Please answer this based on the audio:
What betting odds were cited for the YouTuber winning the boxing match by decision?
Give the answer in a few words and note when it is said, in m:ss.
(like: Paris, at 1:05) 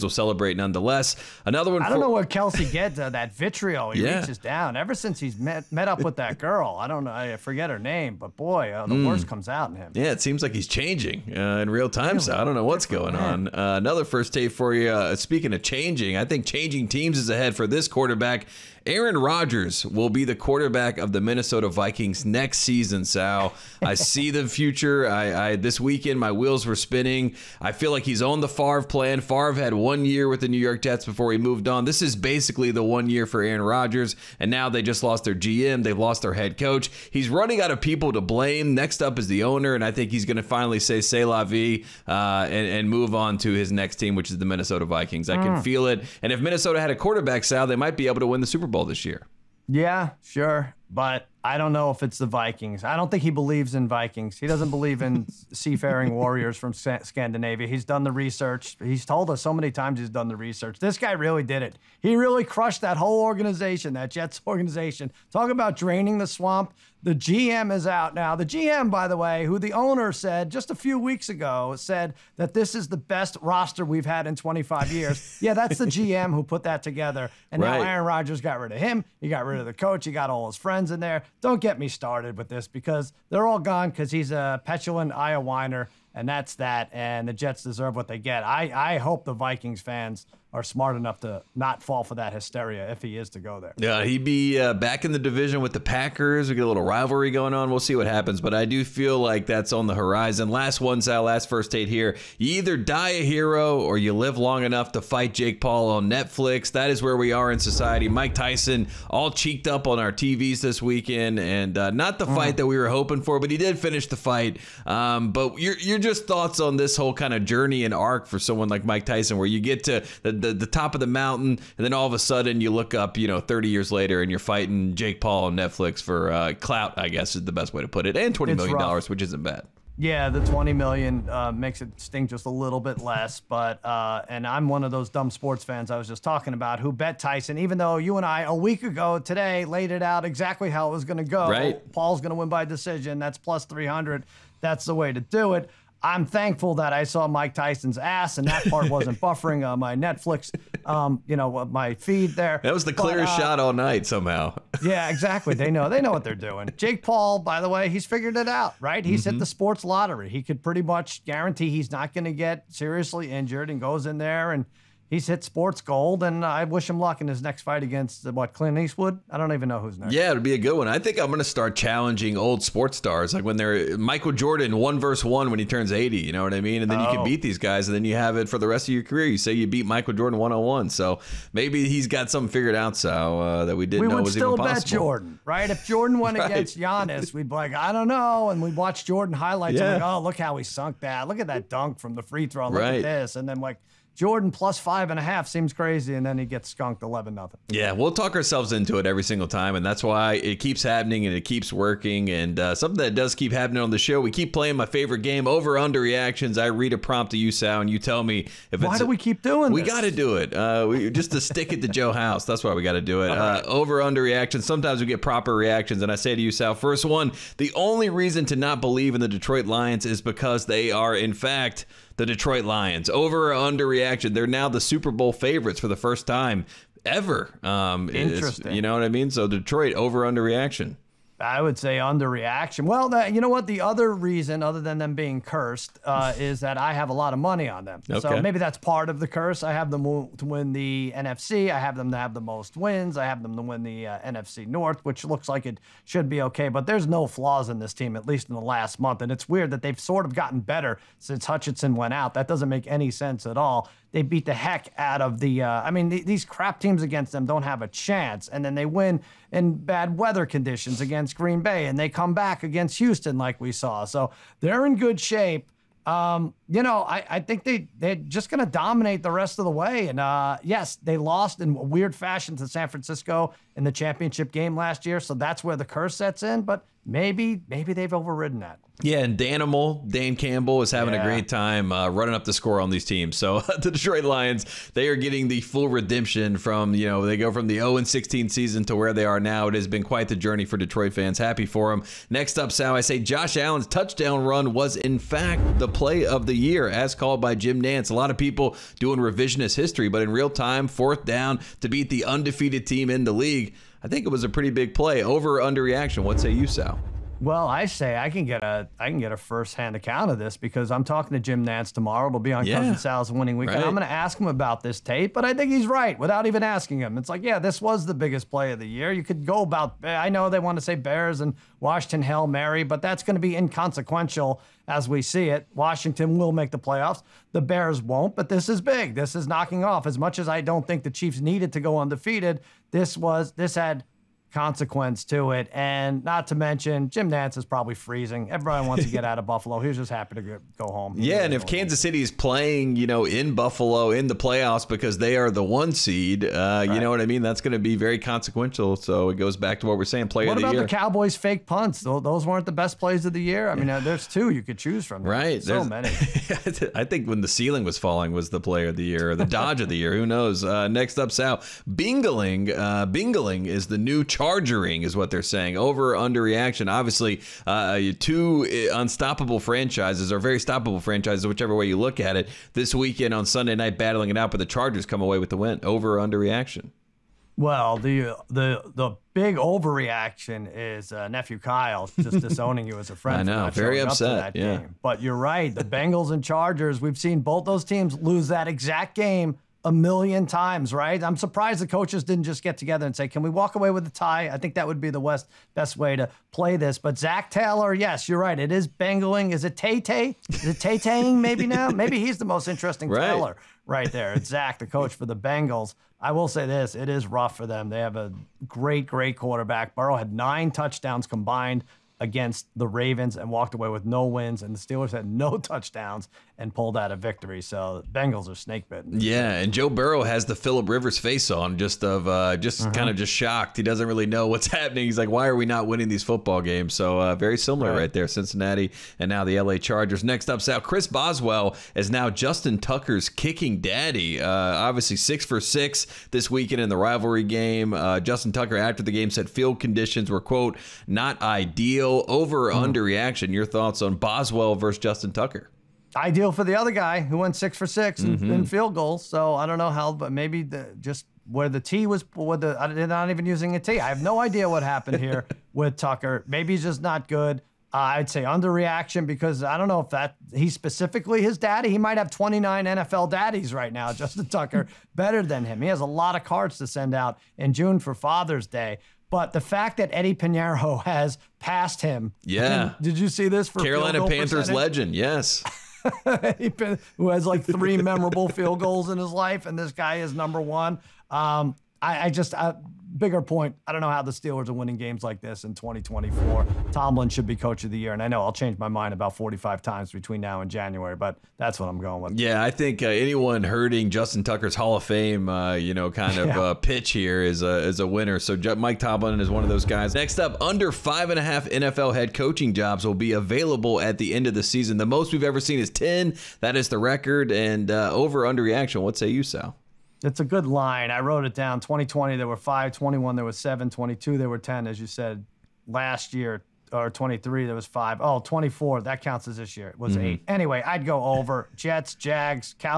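+300, at 2:23.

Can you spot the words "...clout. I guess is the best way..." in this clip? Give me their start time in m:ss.
2:06.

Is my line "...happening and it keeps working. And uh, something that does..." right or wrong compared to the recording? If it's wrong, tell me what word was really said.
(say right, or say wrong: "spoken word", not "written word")
right.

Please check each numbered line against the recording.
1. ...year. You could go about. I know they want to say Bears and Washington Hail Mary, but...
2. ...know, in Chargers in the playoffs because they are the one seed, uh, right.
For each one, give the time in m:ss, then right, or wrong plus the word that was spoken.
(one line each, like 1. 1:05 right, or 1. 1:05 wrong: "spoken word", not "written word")
1. 5:18 right
2. 5:43 wrong: "Buffalo", not "Chargers".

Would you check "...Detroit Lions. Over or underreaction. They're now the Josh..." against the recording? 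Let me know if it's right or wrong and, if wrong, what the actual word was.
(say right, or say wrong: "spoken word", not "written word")
wrong: "Super", not "Josh".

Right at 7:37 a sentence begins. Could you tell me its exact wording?
Uh, I'd say underreaction because I don't know if that he specifically his daddy.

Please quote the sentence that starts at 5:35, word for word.
And not to mention, Jim Nantz is probably freezing.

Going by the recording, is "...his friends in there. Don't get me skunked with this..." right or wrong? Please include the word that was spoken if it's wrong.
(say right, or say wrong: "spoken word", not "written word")
wrong: "started", not "skunked".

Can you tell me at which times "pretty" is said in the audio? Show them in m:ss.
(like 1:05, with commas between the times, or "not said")
2:40, 5:04.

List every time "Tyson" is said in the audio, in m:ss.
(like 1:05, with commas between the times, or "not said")
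1:48, 1:59, 2:17, 2:27.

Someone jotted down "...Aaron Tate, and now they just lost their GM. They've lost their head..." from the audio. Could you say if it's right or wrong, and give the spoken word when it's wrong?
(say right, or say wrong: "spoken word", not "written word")
wrong: "Rodgers", not "Tate".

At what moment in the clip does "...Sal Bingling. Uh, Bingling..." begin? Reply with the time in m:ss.
6:01.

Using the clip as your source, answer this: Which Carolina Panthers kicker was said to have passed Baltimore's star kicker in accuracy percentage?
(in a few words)
Eddy Piñeiro.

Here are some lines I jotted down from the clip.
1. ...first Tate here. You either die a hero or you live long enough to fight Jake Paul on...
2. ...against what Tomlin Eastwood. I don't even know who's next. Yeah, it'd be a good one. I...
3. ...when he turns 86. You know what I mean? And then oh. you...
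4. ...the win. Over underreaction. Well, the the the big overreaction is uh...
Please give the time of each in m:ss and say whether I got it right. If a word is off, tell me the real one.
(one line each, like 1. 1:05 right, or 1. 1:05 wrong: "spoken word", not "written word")
1. 1:41 right
2. 2:47 wrong: "Clint", not "Tomlin"
3. 2:55 wrong: "80", not "86"
4. 6:15 right.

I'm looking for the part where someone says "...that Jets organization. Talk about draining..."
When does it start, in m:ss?
1:03.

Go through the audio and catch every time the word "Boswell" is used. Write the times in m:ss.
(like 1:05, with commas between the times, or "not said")
7:11, 7:24.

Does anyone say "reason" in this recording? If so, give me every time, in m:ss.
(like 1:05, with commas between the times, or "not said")
3:38, 3:54.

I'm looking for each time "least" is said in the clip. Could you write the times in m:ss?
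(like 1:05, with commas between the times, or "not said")
4:08.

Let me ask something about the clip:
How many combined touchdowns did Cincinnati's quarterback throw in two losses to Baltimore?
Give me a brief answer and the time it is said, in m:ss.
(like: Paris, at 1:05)
9, at 6:50.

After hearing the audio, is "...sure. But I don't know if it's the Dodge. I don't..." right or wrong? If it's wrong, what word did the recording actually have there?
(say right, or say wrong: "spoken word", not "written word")
wrong: "Vikings", not "Dodge".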